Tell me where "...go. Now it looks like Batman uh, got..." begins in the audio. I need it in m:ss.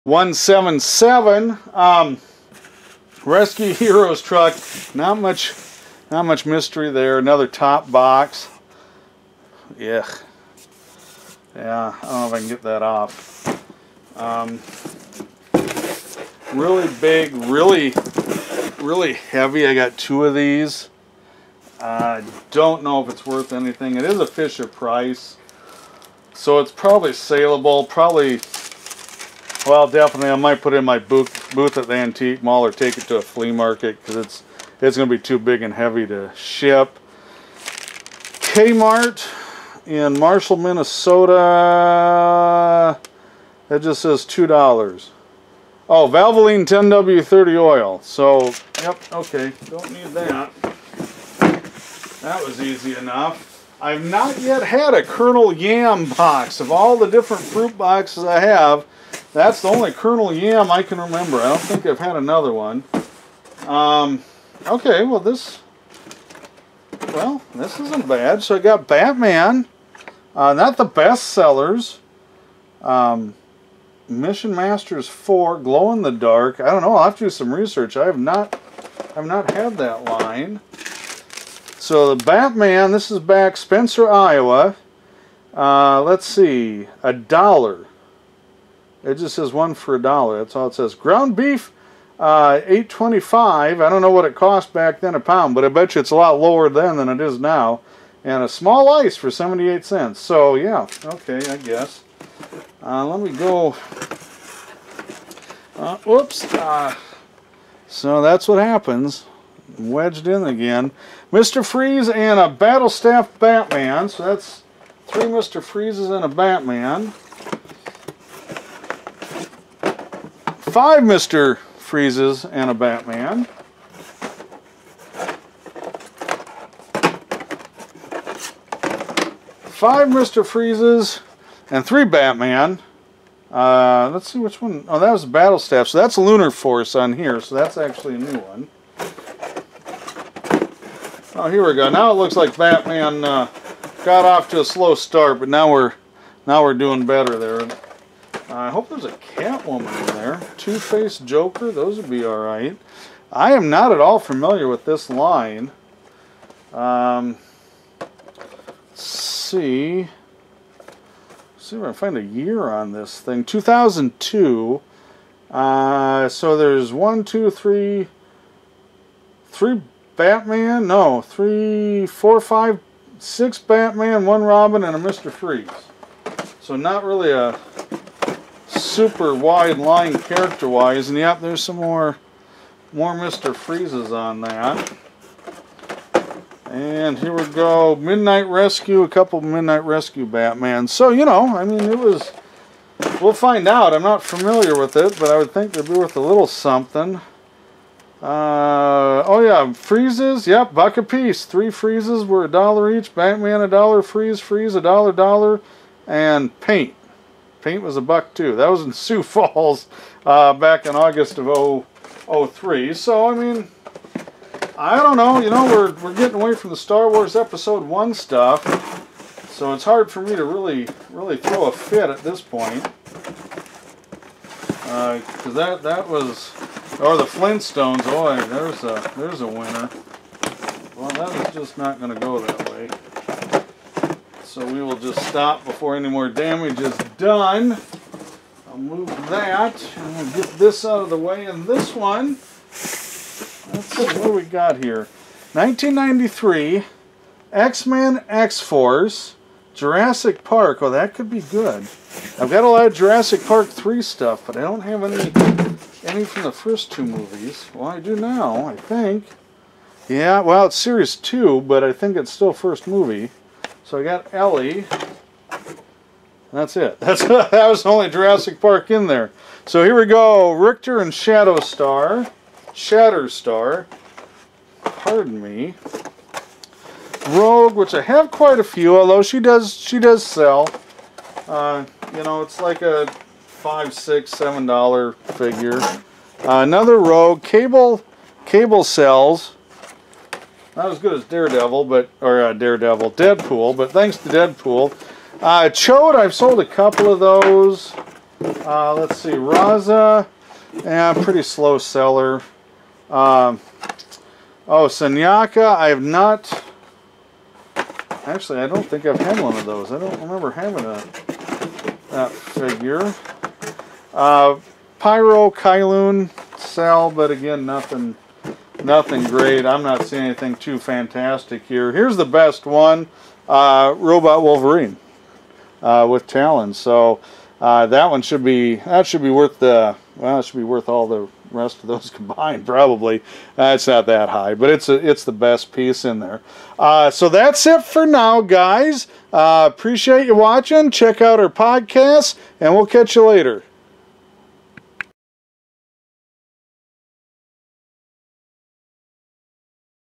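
2:21.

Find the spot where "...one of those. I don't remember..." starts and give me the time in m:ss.
5:09.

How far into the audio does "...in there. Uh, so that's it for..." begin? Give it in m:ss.
5:36.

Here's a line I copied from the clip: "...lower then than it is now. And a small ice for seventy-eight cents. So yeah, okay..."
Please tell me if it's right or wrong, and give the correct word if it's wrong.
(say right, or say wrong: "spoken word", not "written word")
right.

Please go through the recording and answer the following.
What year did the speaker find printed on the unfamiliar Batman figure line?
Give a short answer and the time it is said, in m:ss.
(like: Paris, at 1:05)
2002, at 2:43.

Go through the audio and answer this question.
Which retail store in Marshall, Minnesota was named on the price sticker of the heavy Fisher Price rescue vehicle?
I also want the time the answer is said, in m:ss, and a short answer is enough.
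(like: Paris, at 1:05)
Kmart, at 0:38.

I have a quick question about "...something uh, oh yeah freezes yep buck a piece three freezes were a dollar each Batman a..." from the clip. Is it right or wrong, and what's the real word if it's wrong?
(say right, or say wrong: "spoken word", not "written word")
right.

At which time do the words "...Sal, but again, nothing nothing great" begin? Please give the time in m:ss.
5:16.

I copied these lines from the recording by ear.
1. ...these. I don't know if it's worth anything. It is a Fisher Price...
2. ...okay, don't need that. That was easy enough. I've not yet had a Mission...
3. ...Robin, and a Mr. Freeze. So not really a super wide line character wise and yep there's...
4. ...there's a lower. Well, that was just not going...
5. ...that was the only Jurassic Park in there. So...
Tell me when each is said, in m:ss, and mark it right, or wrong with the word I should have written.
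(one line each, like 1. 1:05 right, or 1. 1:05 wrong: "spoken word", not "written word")
1. 0:20 right
2. 0:49 wrong: "Colonel", not "Mission"
3. 2:54 right
4. 3:49 wrong: "winner", not "lower"
5. 4:27 right.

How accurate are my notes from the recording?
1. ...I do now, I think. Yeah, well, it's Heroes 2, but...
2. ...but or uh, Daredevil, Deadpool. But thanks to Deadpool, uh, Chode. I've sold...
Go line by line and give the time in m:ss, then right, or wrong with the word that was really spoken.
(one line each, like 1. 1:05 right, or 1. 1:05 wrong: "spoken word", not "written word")
1. 4:17 wrong: "Series", not "Heroes"
2. 4:51 right.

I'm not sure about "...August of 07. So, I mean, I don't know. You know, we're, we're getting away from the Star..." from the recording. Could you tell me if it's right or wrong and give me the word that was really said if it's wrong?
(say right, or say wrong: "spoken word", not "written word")
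wrong: "03", not "07".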